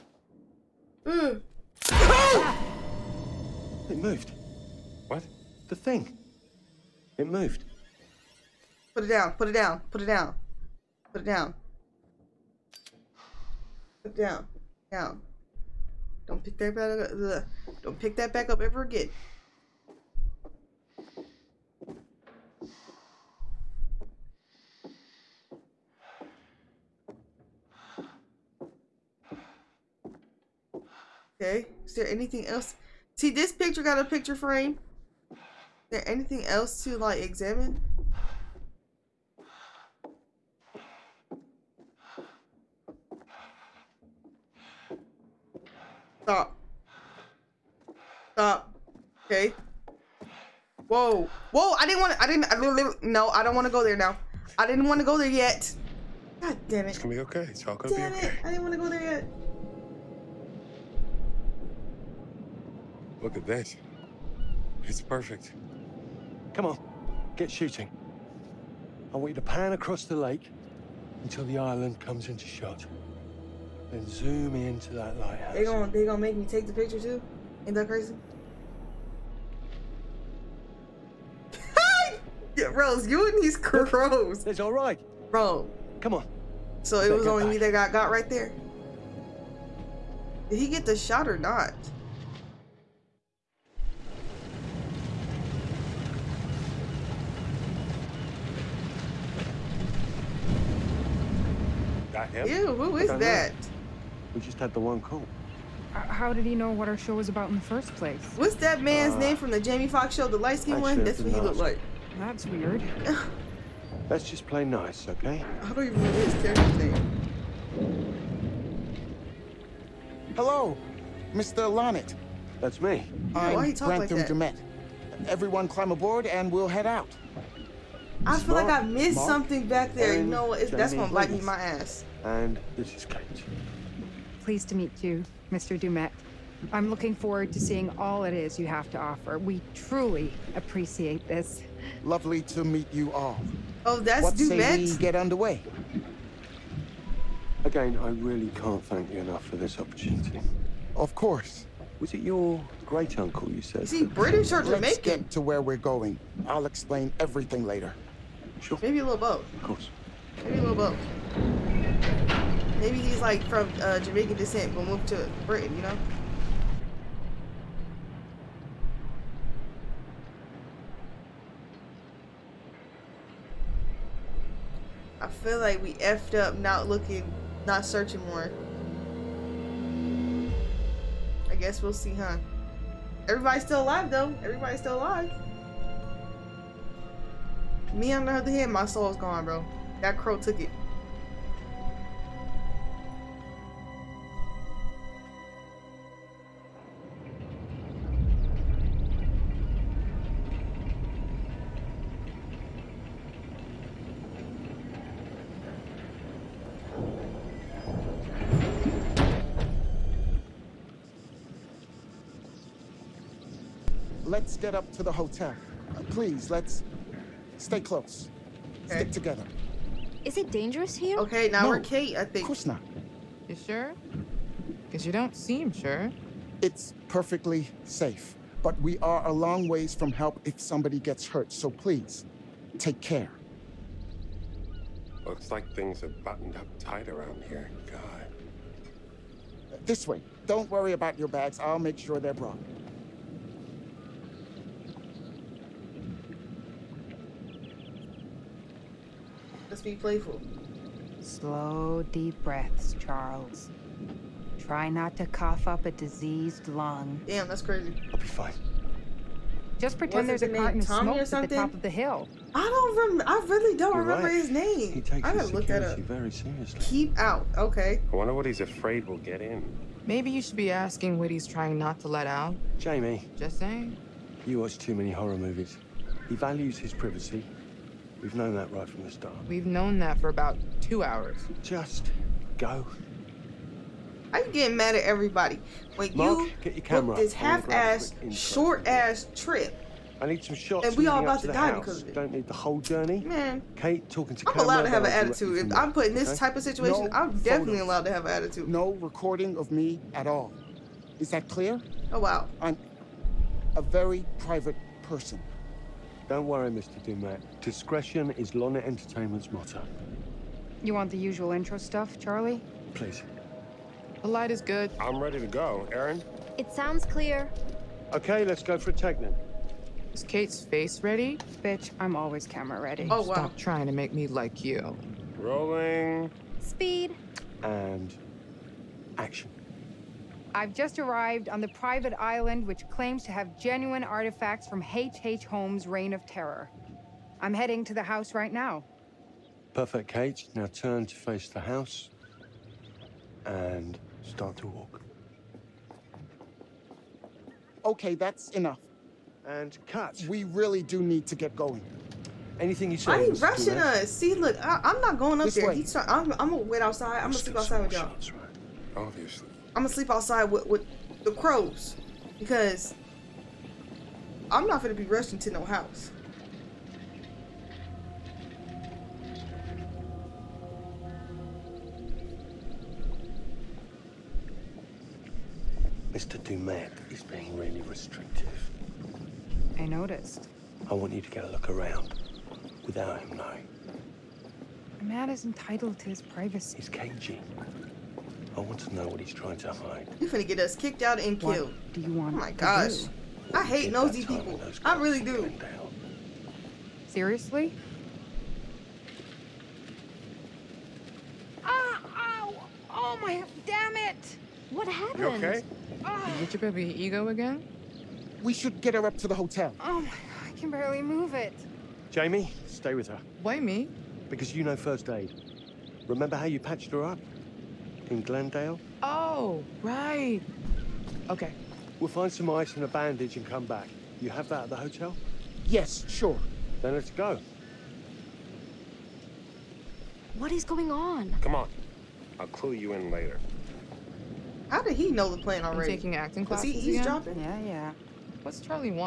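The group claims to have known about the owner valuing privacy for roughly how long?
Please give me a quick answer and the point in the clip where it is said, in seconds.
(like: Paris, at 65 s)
2 hours, at 280 s.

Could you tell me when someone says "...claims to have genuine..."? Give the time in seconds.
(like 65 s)
332 s.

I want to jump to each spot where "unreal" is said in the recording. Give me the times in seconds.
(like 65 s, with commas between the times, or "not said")
not said.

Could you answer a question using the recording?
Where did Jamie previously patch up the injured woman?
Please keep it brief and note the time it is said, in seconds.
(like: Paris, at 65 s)
Glendale, at 418 s.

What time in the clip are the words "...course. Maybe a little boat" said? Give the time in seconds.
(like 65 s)
159 s.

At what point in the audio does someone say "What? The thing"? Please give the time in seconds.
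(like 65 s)
5 s.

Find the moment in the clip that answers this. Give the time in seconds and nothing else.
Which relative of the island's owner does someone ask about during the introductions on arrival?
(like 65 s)
152 s.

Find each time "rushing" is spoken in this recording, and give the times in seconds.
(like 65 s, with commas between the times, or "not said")
353 s, 365 s.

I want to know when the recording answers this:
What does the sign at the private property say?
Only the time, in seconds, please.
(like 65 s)
266 s.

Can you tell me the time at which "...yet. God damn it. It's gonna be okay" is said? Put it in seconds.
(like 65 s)
55 s.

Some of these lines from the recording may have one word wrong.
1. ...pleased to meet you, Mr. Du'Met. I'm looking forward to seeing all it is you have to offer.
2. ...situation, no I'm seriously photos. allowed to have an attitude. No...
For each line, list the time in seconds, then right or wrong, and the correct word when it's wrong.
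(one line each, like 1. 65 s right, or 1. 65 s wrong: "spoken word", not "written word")
1. 134 s right
2. 296 s wrong: "definitely", not "seriously".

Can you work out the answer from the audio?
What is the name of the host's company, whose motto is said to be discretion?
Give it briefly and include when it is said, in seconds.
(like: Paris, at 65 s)
Lonnit Entertainment, at 308 s.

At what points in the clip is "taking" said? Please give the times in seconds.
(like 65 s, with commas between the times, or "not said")
435 s.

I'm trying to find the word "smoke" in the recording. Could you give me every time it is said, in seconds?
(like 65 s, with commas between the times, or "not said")
260 s.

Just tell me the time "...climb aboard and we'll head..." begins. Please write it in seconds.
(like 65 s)
125 s.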